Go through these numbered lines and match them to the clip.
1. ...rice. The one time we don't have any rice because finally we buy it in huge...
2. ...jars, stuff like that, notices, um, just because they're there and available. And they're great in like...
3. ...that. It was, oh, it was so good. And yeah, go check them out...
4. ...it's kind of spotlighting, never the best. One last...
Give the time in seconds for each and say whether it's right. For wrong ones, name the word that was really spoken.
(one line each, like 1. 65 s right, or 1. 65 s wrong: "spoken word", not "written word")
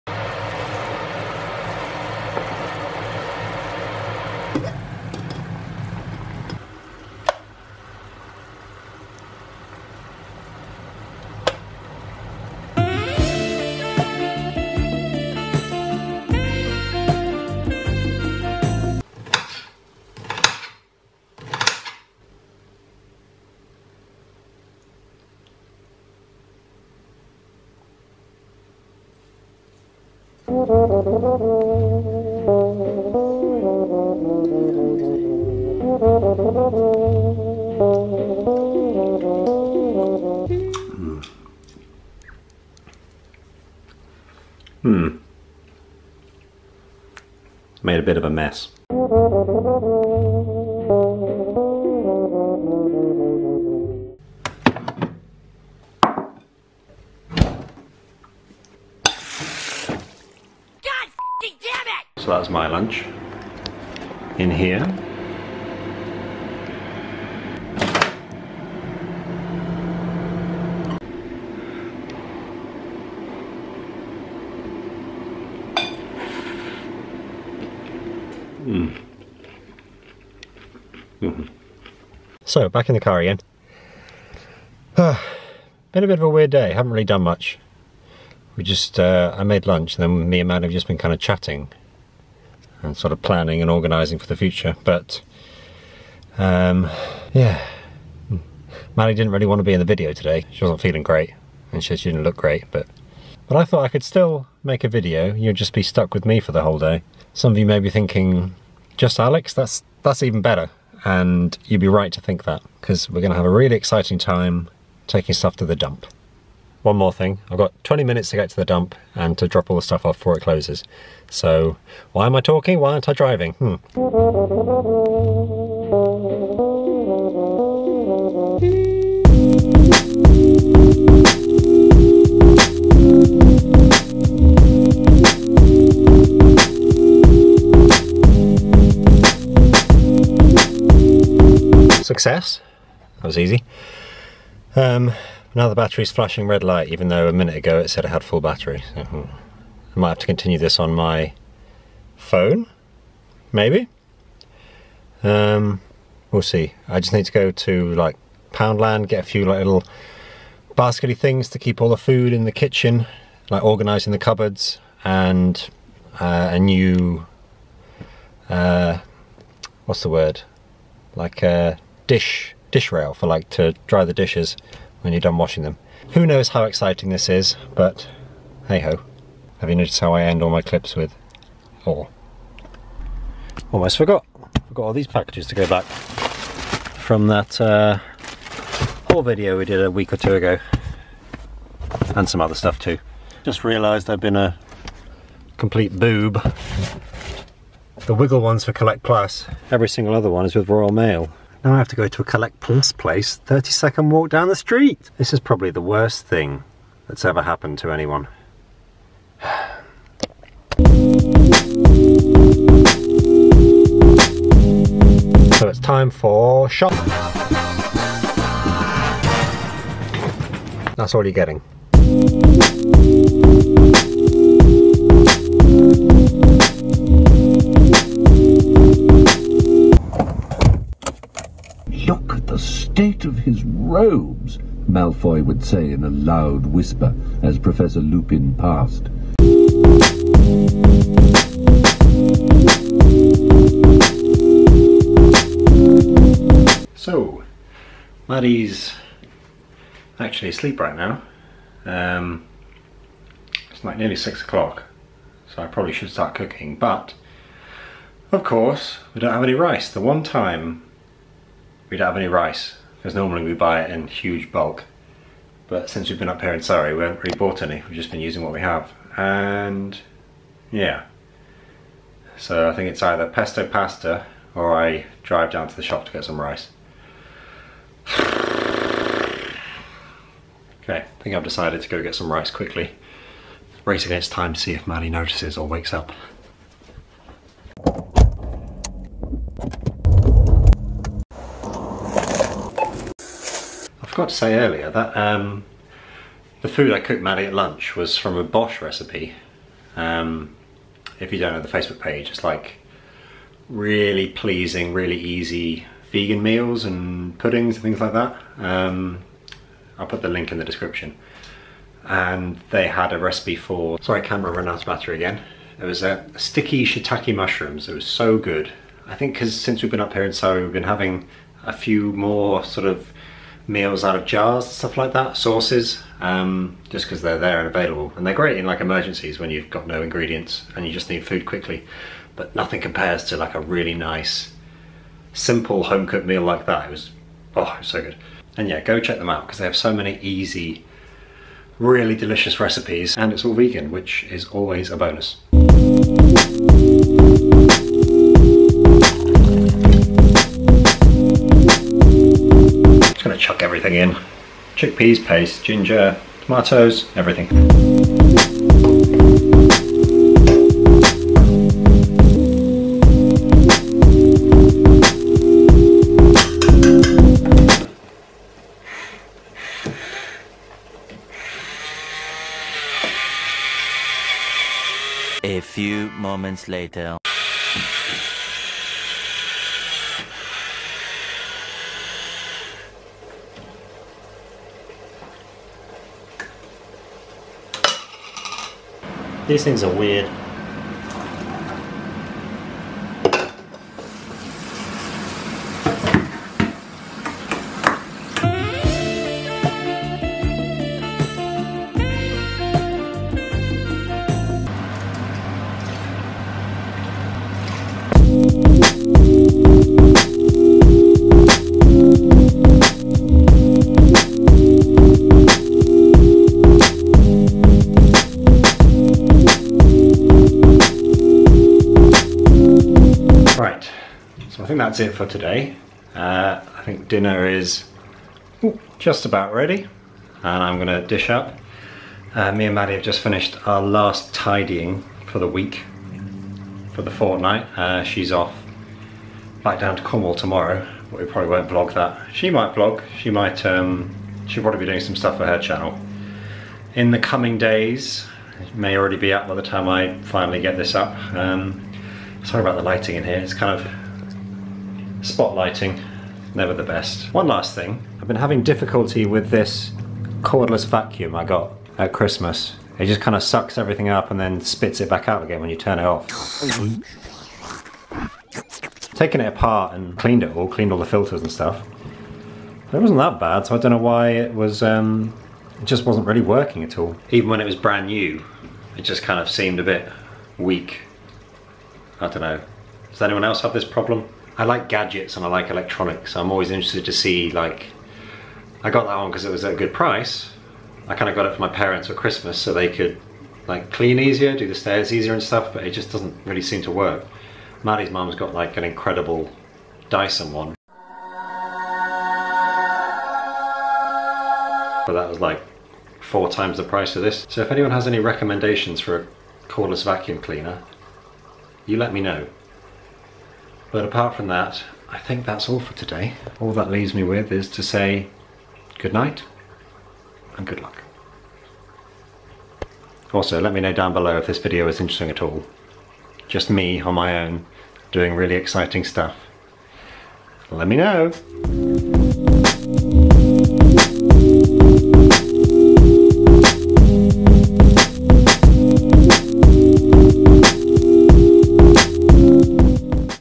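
1. 259 s wrong: "normally", not "finally"
2. 324 s wrong: "sauces", not "notices"
3. 336 s right
4. 453 s right.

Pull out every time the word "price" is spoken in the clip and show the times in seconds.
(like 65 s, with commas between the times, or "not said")
489 s, 506 s.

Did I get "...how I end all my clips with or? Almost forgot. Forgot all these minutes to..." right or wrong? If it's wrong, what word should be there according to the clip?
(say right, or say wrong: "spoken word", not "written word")
wrong: "packages", not "minutes".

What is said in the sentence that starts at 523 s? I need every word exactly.
Also, let me know down below if this video is interesting at all.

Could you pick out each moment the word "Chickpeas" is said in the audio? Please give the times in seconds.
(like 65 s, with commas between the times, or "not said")
354 s.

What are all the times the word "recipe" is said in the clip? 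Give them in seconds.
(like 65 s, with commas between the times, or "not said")
298 s, 313 s, 342 s.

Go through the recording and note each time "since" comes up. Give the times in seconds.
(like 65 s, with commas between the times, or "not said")
265 s, 319 s.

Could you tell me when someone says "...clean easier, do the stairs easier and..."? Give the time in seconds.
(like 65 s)
493 s.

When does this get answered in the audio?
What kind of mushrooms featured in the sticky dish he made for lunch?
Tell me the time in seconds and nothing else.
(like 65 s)
316 s.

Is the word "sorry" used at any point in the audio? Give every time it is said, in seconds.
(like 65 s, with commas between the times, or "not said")
314 s, 452 s.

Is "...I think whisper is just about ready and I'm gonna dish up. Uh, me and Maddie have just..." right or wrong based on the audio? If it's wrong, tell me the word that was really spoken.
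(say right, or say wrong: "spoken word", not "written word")
wrong: "dinner", not "whisper".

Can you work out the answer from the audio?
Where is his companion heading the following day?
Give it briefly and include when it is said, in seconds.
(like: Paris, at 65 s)
Cornwall, at 440 s.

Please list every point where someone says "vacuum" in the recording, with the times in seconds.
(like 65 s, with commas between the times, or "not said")
460 s, 510 s.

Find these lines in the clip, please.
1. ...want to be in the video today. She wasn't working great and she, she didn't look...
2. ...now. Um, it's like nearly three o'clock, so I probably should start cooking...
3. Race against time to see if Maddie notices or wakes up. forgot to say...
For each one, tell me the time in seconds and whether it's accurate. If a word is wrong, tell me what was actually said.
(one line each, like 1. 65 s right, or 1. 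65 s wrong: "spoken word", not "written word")
1. 99 s wrong: "feeling", not "working"
2. 250 s wrong: "six", not "three"
3. 283 s right.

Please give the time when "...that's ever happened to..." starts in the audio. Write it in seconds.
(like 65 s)
207 s.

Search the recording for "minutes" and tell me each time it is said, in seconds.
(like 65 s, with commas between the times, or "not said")
118 s, 147 s.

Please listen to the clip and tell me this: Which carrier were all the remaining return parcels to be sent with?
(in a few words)
Royal Mail.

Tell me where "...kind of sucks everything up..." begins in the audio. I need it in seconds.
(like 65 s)
463 s.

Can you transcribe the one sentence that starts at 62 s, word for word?
So that's my lunch in here.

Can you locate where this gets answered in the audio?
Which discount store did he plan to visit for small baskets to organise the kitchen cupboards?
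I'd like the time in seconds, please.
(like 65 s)
158 s.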